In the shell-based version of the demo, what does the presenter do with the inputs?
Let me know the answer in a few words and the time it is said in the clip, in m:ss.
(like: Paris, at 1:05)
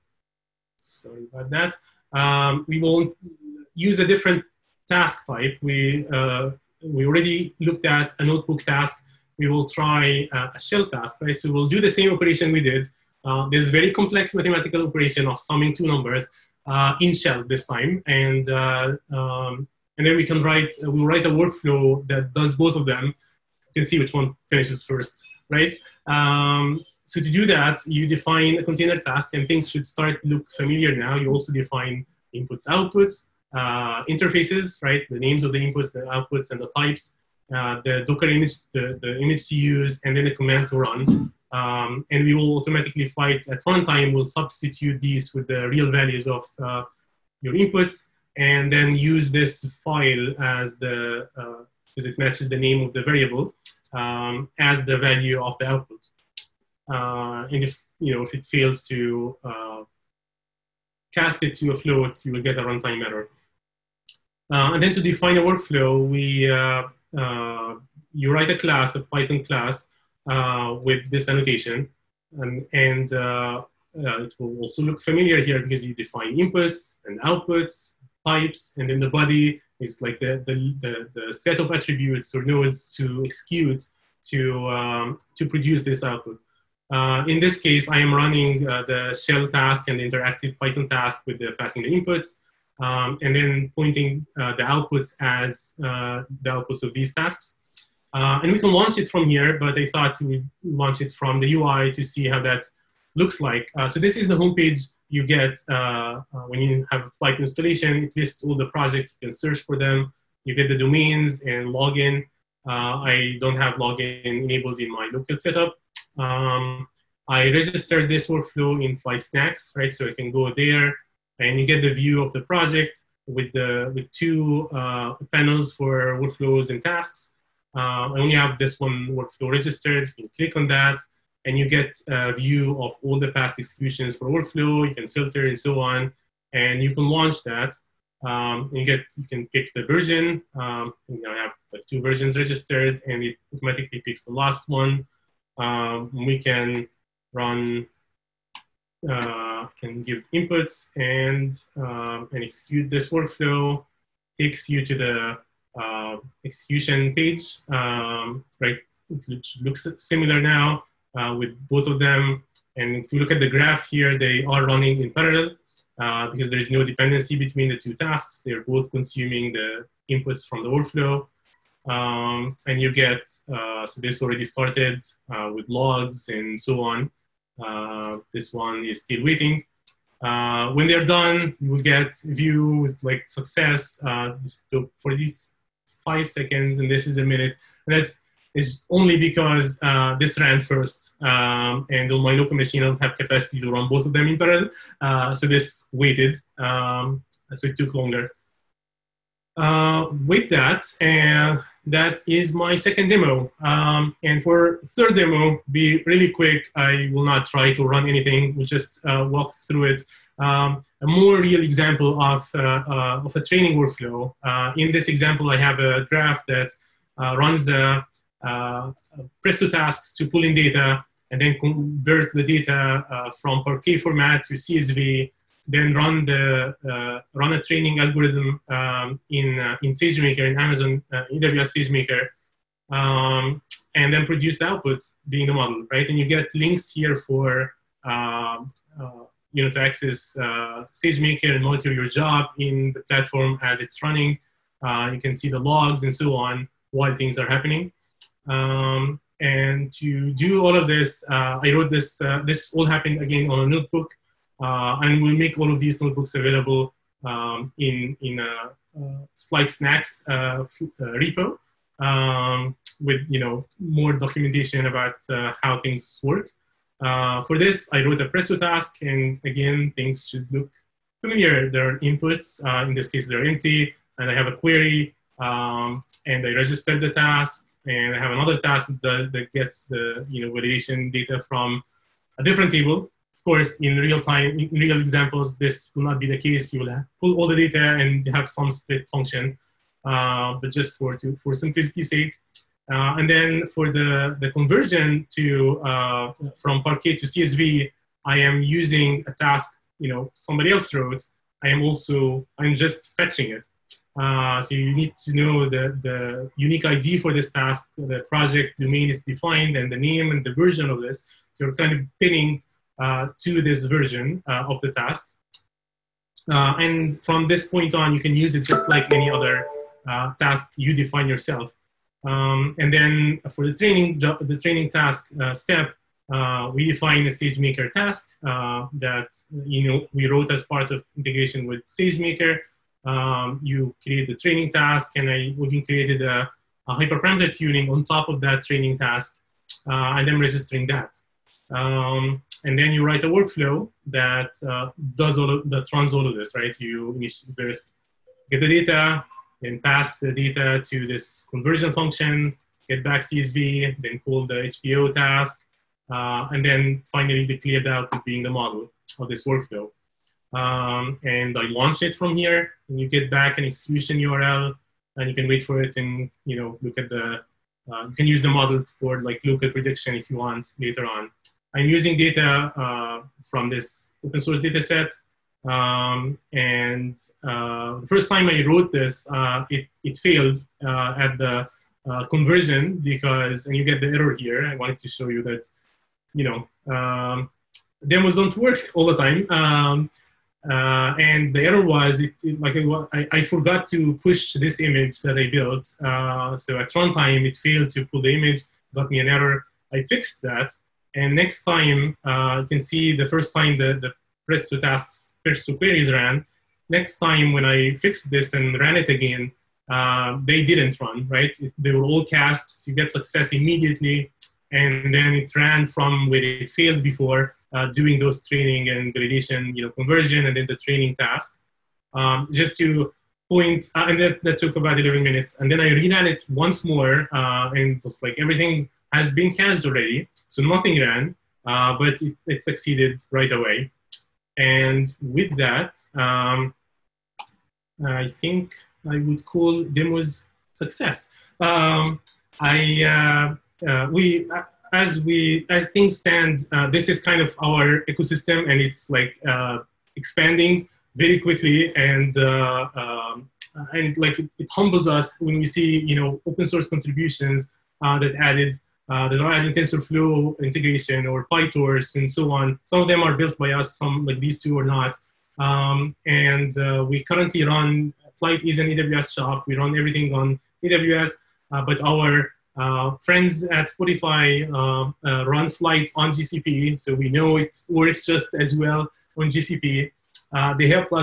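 Summing two numbers, at 0:15.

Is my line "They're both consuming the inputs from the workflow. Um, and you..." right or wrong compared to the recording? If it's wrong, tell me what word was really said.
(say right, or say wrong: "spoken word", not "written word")
right.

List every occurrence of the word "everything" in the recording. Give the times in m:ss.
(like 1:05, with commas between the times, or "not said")
7:08, 7:49.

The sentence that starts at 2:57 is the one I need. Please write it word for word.
Uh, this one is still waiting.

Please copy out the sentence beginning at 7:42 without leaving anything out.
Some of them are built by us, some like these two are not.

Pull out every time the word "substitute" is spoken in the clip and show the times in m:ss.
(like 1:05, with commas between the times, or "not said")
0:44.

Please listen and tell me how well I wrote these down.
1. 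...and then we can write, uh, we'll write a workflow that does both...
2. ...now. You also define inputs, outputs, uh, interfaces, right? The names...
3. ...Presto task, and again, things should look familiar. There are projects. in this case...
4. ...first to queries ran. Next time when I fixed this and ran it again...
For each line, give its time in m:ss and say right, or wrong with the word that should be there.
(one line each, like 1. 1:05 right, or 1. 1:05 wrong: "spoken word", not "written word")
1. 0:19 right
2. 0:30 right
3. 4:28 wrong: "inputs", not "projects"
4. 6:45 right.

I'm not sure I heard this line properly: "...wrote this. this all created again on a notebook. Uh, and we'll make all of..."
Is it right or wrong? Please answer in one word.
wrong.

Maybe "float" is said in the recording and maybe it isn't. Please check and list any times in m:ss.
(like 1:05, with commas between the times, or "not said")
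1:01.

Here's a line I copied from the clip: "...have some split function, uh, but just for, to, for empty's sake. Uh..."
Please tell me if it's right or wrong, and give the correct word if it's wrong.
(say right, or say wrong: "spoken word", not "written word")
wrong: "simplicity", not "empty".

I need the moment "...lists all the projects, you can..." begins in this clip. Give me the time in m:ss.
1:48.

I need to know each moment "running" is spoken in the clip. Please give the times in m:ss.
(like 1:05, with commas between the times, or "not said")
1:28, 2:44, 4:04.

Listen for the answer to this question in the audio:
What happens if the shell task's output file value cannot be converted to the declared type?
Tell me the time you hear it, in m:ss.
1:02.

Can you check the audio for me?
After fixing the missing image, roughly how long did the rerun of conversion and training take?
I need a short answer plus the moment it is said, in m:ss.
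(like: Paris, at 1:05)
About 11 minutes, at 7:04.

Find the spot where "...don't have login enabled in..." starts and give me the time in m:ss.
1:53.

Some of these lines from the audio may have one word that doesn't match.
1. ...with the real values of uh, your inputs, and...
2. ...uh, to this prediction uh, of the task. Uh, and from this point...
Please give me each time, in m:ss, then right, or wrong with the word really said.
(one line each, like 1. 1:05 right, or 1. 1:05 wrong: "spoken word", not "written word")
1. 0:45 right
2. 5:12 wrong: "version", not "prediction".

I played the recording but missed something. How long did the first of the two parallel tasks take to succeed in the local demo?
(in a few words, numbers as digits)
5 seconds.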